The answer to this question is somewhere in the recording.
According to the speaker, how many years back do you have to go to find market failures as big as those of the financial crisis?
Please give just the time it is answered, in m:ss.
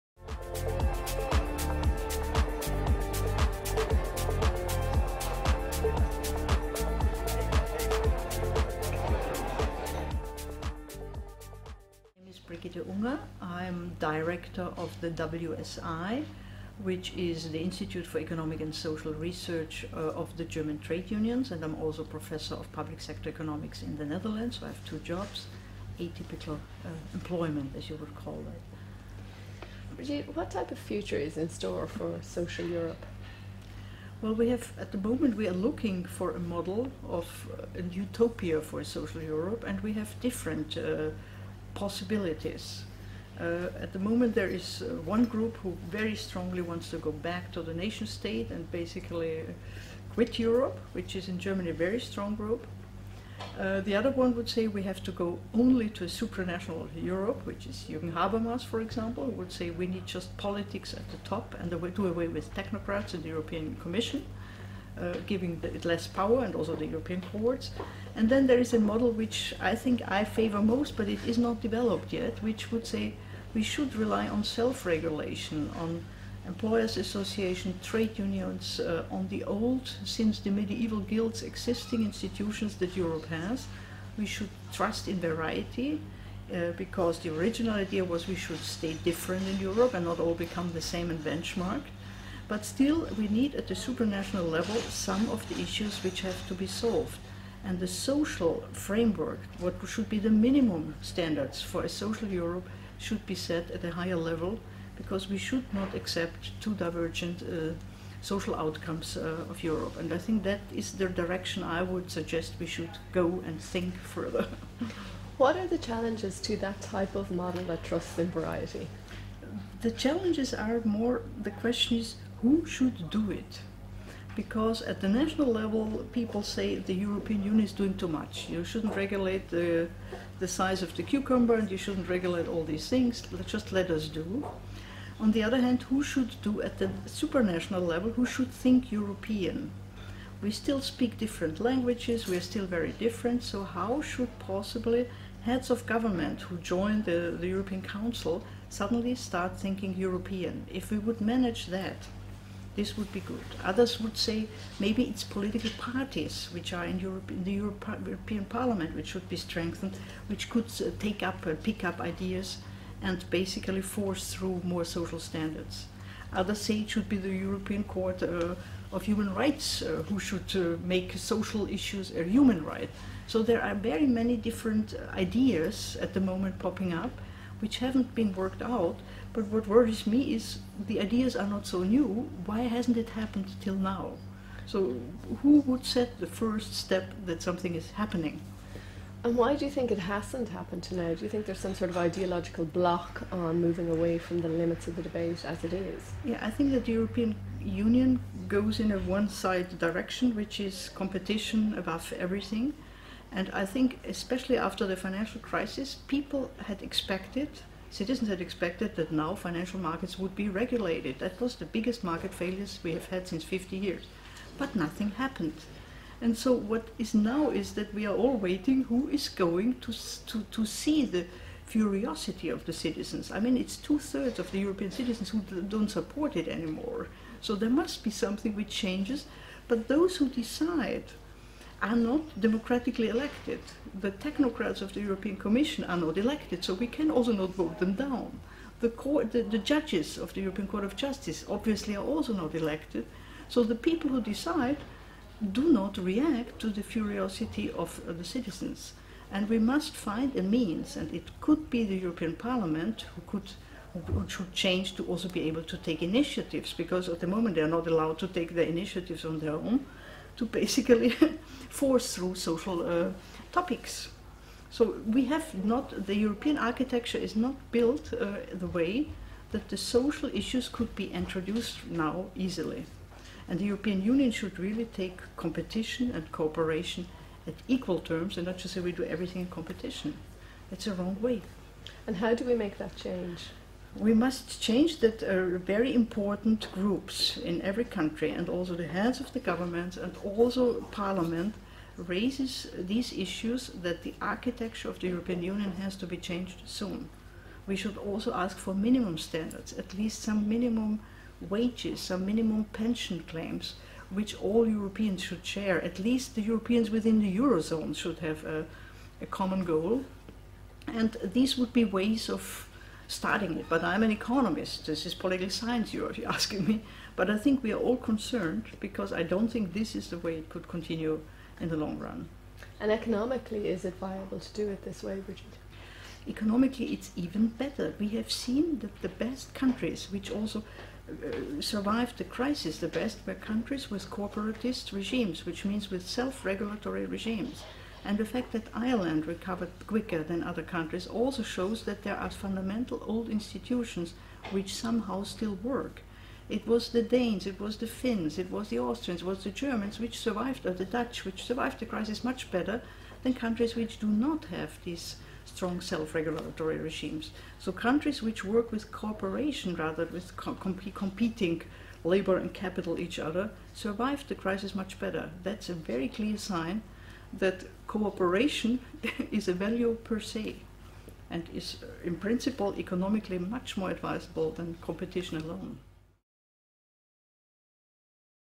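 3:33.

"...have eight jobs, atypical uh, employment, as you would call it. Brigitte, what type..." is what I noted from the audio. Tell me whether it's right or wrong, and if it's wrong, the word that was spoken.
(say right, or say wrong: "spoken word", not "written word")
wrong: "two", not "eight".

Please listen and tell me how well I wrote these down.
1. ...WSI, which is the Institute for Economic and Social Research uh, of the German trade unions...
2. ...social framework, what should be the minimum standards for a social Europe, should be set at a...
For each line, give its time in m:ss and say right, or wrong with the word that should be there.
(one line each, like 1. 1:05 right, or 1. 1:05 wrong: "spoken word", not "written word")
1. 0:15 right
2. 1:37 right.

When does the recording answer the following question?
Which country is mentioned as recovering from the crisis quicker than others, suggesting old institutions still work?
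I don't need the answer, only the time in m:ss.
5:38.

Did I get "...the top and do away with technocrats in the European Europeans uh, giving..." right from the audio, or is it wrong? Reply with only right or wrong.
wrong.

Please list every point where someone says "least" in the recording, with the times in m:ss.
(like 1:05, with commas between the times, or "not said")
4:59, 5:05.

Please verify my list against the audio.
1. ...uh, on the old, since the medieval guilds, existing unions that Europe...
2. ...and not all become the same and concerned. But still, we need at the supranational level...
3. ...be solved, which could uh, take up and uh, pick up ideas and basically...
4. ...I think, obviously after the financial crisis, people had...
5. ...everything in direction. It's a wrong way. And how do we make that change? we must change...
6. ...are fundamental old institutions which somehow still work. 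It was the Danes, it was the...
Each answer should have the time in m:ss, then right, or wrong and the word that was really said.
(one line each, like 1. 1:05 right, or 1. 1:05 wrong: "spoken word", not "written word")
1. 1:18 wrong: "institutions", not "unions"
2. 1:29 wrong: "benchmarked", not "concerned"
3. 2:39 wrong: "strengthened", not "solved"
4. 3:23 wrong: "especially", not "obviously"
5. 4:39 wrong: "competition", not "direction"
6. 5:42 right.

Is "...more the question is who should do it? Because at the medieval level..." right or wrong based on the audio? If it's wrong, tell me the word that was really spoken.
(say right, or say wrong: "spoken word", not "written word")
wrong: "national", not "medieval".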